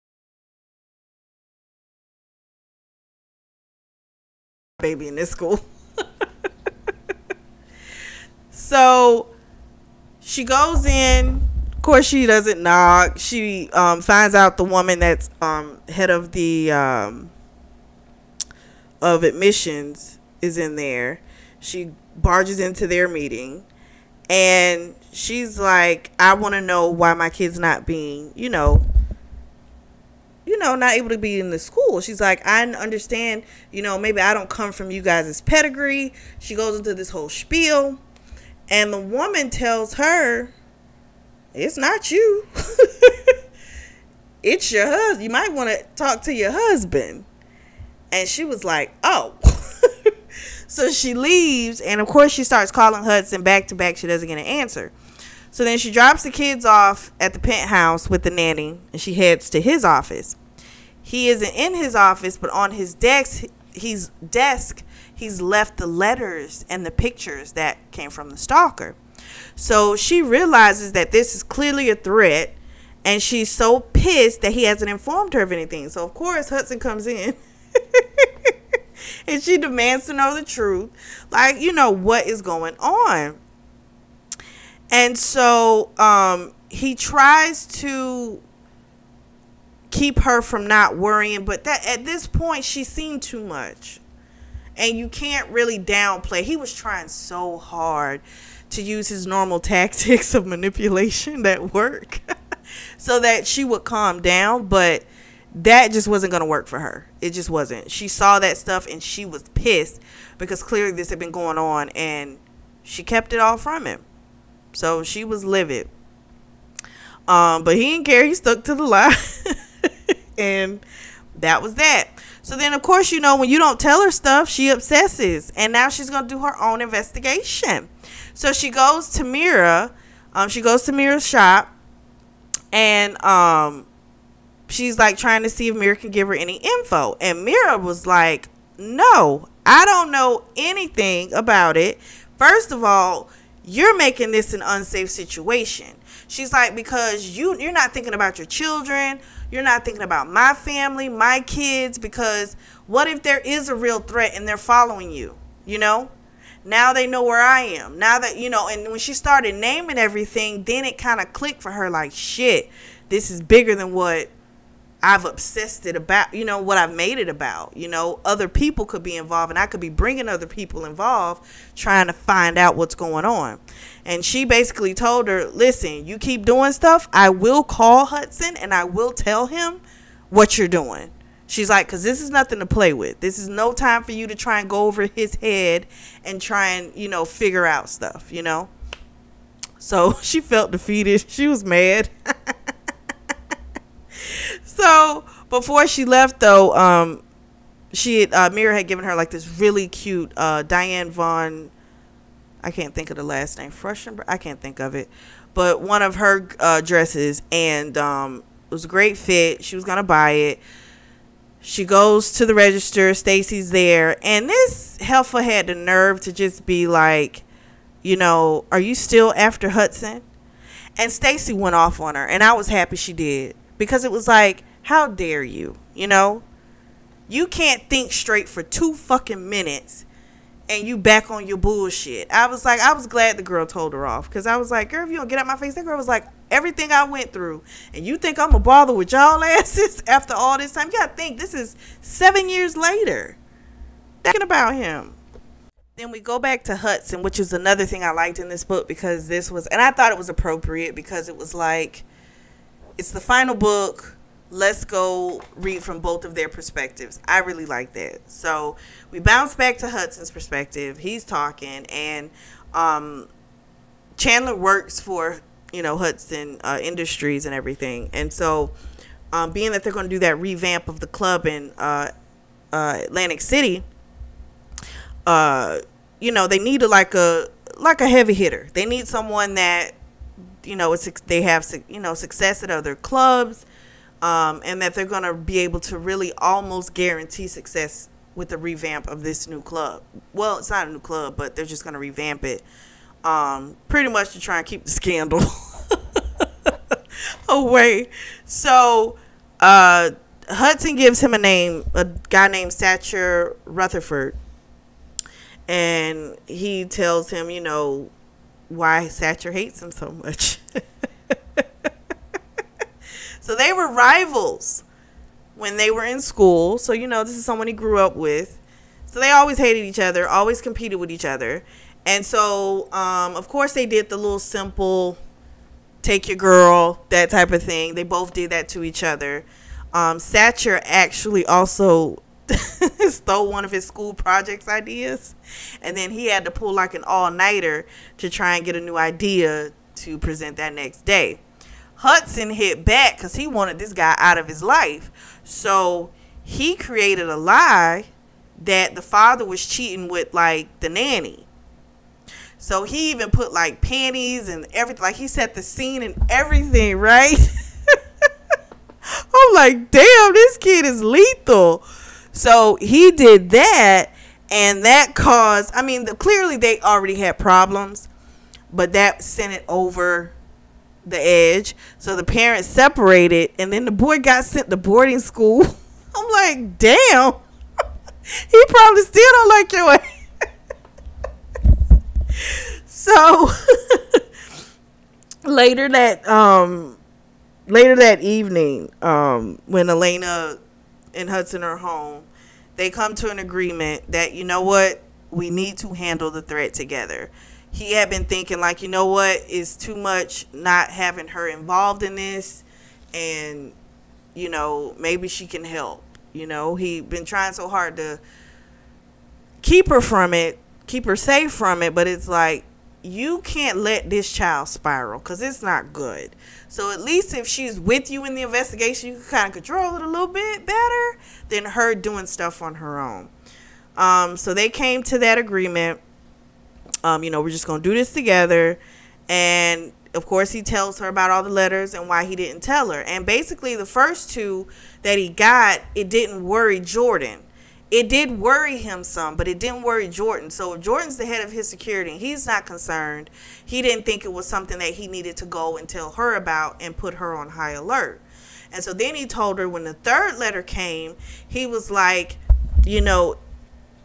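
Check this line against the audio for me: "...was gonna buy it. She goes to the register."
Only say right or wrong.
right.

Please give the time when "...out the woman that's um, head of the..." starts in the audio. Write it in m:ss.
0:14.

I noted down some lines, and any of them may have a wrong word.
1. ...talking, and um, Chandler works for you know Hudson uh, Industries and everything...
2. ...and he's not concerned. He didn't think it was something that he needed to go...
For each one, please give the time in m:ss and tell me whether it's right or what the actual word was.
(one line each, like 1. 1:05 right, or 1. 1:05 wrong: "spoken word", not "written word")
1. 4:21 right
2. 7:22 right.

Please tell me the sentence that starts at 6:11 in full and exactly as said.
So the parents separated, and then the boy got sent to boarding school.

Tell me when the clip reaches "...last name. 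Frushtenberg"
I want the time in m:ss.
3:23.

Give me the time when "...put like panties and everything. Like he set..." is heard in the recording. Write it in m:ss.
5:53.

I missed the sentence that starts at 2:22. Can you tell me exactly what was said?
First of all, you're making this an unsafe situation.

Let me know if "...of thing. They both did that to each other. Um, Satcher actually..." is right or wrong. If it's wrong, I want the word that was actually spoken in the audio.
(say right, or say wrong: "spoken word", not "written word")
right.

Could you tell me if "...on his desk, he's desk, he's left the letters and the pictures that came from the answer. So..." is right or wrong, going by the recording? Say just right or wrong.
wrong.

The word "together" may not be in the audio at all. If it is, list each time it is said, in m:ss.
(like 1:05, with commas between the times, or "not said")
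6:36, 7:08.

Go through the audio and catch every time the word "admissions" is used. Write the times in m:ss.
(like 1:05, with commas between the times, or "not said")
0:19.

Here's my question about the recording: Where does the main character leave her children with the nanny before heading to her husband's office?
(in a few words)
the penthouse.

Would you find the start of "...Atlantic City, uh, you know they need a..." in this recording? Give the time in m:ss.
4:33.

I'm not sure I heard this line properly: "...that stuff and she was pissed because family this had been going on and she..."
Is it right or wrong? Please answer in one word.
wrong.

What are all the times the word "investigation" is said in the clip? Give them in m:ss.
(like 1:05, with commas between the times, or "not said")
2:06, 6:58.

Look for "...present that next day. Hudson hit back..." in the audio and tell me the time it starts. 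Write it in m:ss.
5:40.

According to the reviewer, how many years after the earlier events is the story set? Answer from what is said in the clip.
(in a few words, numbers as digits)
7.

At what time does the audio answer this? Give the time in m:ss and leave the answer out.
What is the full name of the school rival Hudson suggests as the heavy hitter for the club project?
5:02.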